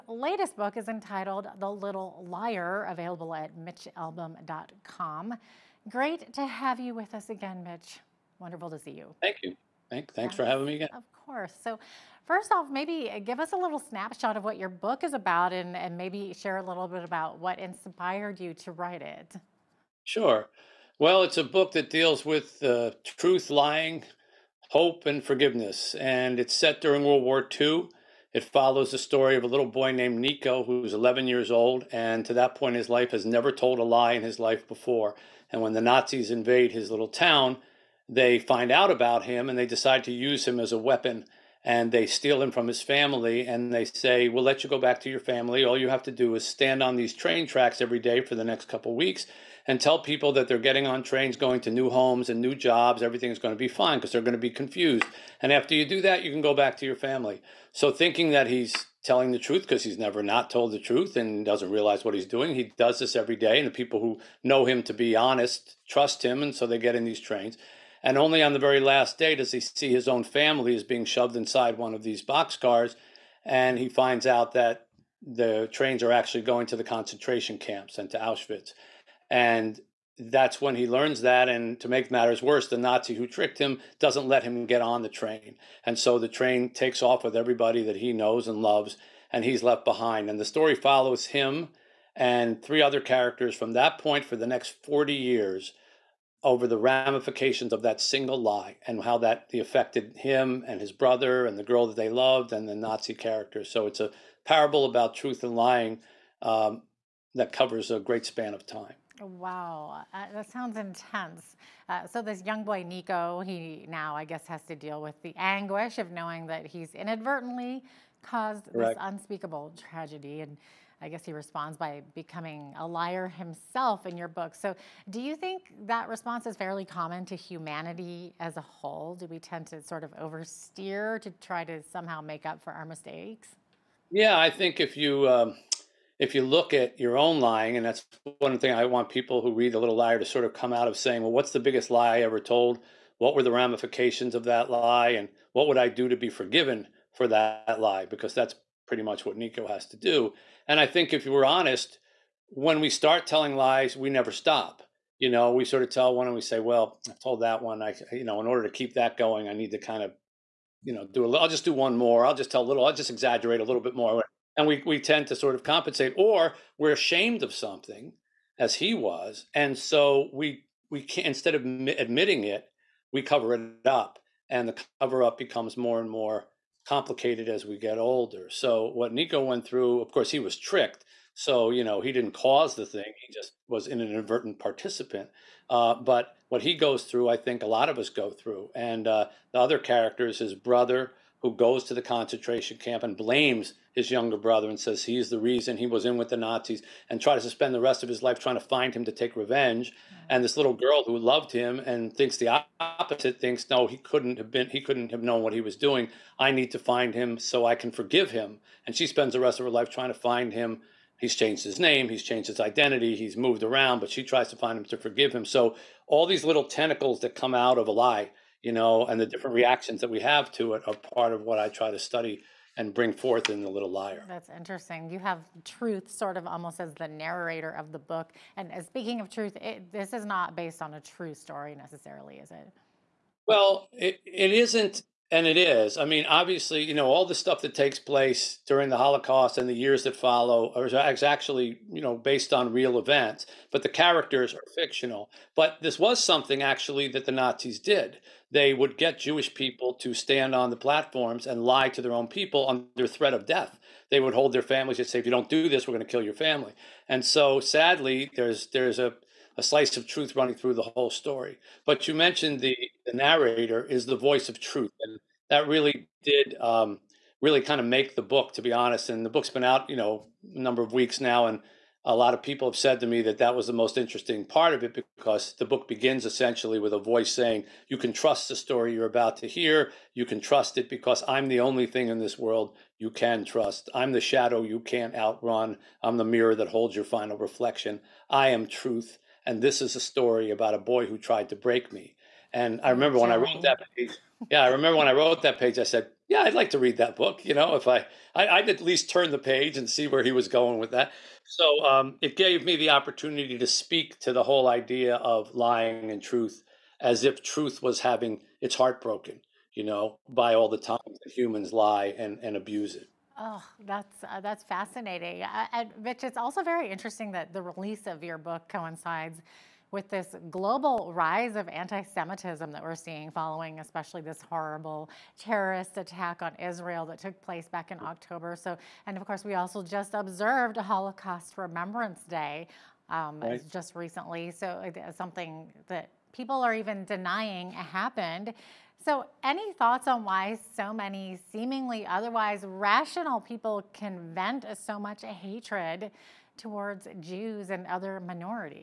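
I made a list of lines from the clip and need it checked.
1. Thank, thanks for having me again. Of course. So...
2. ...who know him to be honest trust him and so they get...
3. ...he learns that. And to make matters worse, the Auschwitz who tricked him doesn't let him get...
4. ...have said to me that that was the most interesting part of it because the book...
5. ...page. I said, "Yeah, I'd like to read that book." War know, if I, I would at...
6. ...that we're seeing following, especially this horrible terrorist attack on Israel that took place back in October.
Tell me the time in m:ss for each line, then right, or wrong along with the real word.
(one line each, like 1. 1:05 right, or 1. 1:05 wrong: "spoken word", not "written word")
1. 0:09 right
2. 1:04 right
3. 1:20 wrong: "Nazi", not "Auschwitz"
4. 4:32 right
5. 4:55 wrong: "You", not "War"
6. 5:22 right.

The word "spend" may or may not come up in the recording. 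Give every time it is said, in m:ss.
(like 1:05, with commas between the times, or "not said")
3:17, 3:29.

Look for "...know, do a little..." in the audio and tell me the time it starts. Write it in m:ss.
2:40.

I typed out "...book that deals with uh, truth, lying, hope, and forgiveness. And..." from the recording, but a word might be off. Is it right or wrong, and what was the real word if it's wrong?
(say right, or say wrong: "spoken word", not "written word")
right.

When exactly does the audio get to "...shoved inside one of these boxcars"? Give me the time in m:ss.
1:11.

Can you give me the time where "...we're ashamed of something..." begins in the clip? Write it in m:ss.
2:46.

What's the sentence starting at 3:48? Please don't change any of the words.
And uh, speaking of truth, it, this is not based on a true story necessarily, is it?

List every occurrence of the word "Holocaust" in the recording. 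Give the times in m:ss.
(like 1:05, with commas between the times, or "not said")
3:58, 5:30.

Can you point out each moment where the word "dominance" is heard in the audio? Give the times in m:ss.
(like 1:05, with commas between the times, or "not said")
not said.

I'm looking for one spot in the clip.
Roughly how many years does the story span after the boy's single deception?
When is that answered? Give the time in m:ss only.
1:34.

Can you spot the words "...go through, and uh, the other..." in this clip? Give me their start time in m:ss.
3:08.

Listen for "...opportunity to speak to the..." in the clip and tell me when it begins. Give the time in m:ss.
5:02.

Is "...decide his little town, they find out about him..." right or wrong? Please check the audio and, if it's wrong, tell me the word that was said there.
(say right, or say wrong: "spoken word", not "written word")
wrong: "invade", not "decide".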